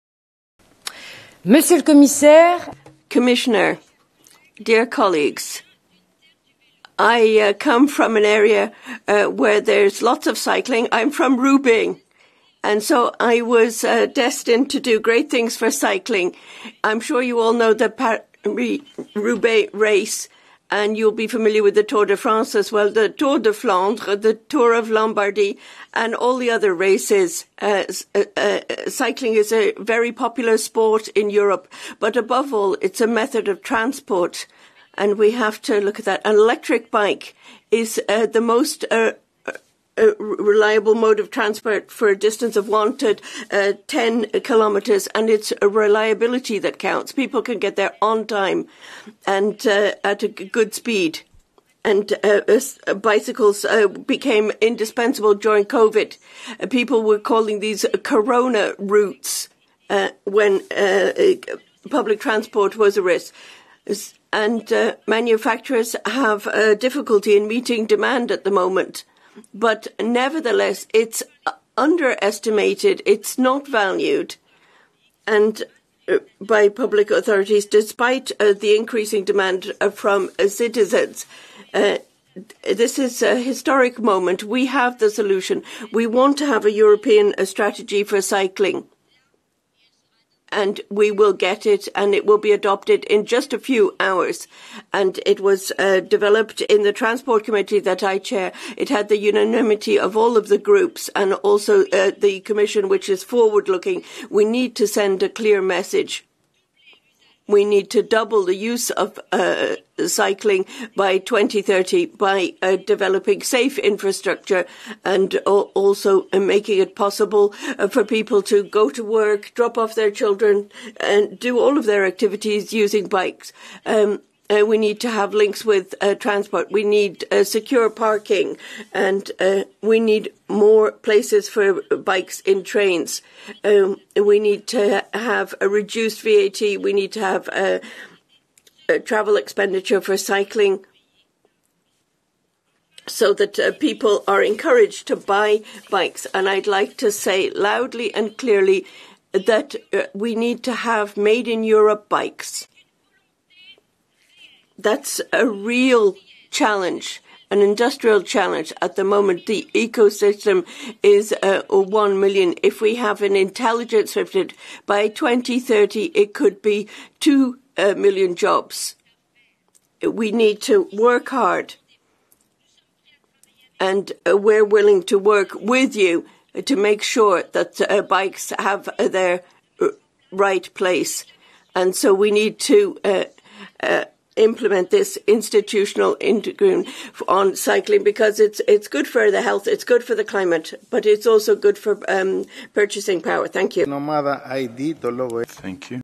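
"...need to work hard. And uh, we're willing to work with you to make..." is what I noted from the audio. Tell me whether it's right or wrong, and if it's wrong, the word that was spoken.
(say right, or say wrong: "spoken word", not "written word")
right.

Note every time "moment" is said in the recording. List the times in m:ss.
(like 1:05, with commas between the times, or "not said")
1:08, 1:23, 2:39.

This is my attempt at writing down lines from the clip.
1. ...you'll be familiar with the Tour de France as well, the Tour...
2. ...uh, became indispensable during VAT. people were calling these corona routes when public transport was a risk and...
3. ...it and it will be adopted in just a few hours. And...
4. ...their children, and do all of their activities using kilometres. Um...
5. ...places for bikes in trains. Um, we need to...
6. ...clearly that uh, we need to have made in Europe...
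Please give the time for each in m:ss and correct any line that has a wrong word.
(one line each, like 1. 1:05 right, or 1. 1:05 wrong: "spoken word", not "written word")
1. 0:20 right
2. 0:53 wrong: "COVID", not "VAT"
3. 1:31 right
4. 1:59 wrong: "bikes", not "kilometres"
5. 2:10 right
6. 2:28 right.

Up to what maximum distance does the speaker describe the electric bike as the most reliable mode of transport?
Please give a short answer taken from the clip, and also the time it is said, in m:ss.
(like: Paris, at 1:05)
10 kilometres, at 0:43.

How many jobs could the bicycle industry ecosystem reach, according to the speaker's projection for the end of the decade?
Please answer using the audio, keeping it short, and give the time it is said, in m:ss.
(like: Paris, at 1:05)
2 million, at 2:47.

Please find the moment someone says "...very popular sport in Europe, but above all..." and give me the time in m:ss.
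0:29.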